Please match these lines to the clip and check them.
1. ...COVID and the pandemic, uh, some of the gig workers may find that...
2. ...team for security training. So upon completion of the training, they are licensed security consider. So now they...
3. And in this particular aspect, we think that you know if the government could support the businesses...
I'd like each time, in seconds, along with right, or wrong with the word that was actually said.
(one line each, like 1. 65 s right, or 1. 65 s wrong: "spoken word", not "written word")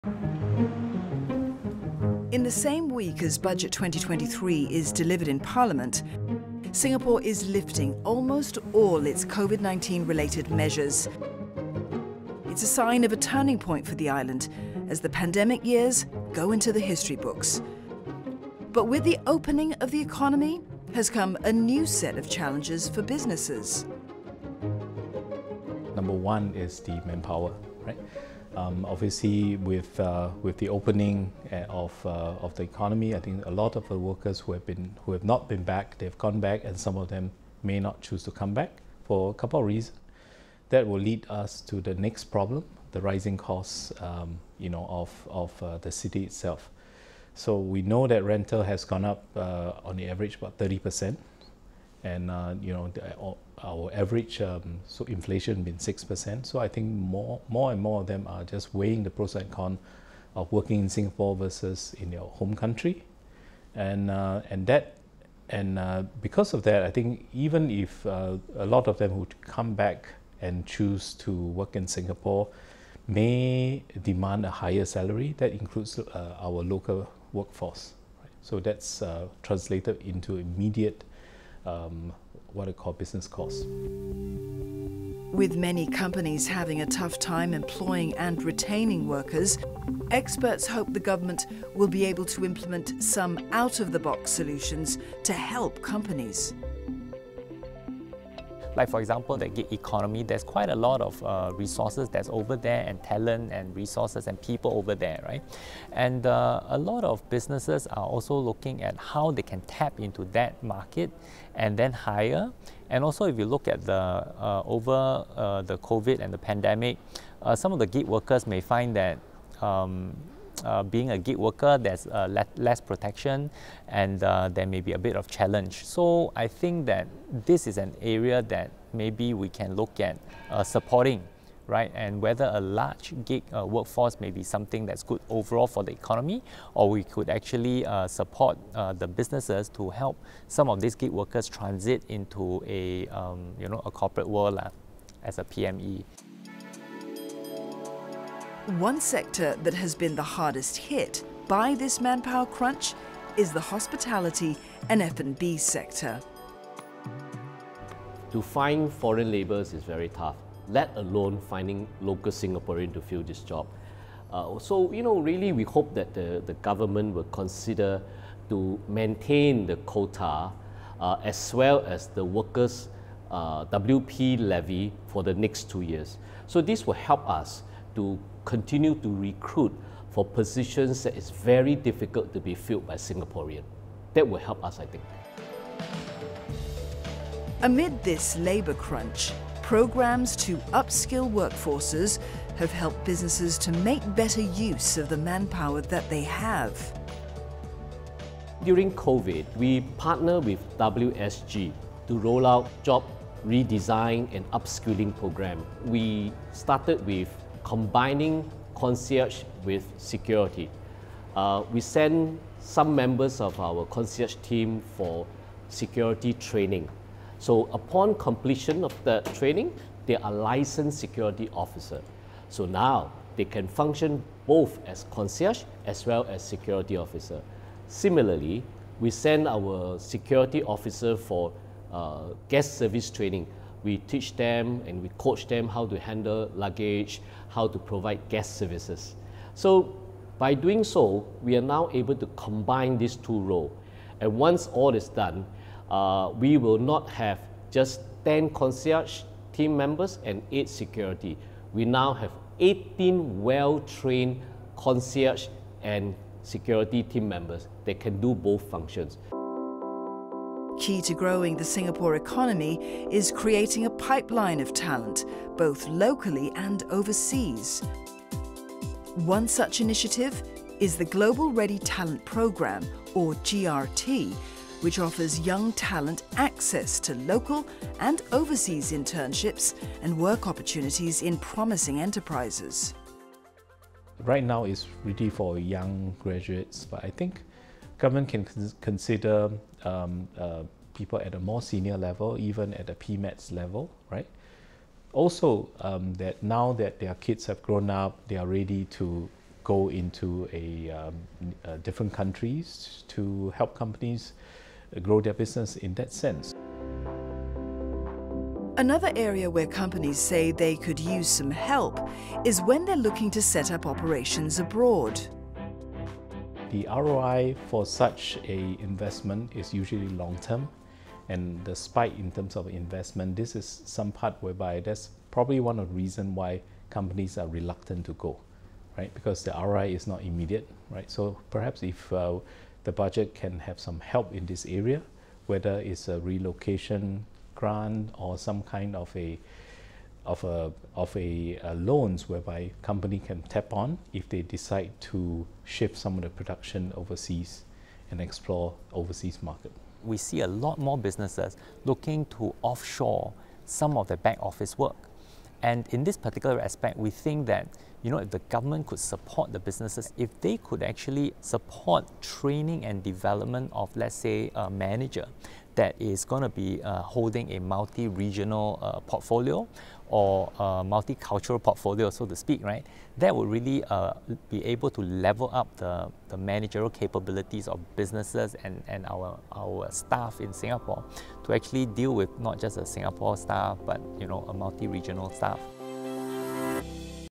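1. 115 s right
2. 214 s wrong: "officer", not "consider"
3. 355 s right.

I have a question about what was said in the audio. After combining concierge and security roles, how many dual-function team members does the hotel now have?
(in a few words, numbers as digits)
18.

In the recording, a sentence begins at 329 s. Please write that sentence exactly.
Because the ROI is not immediate, right?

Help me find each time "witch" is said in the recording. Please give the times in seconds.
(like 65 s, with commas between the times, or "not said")
not said.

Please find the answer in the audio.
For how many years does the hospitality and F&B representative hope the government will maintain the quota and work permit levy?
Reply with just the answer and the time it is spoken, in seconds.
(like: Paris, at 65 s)
2 years, at 175 s.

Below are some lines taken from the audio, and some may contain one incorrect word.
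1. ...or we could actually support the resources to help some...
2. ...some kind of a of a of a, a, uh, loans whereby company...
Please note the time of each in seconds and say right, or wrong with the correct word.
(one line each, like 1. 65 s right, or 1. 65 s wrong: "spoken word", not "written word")
1. 136 s wrong: "businesses", not "resources"
2. 338 s right.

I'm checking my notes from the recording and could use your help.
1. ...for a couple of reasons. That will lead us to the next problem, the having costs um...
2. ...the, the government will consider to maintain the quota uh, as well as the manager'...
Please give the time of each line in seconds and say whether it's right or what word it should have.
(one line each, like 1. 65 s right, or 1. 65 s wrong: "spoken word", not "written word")
1. 39 s wrong: "rising", not "having"
2. 166 s wrong: "workers", not "manager".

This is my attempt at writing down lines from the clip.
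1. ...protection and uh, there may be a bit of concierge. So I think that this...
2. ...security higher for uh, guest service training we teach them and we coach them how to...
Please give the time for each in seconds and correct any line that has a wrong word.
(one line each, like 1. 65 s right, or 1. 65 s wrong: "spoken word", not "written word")
1. 122 s wrong: "challenge", not "concierge"
2. 229 s wrong: "officer", not "higher".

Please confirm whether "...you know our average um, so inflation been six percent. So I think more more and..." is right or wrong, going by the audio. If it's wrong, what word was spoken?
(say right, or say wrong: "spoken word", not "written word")
right.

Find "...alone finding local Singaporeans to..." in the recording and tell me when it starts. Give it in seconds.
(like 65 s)
160 s.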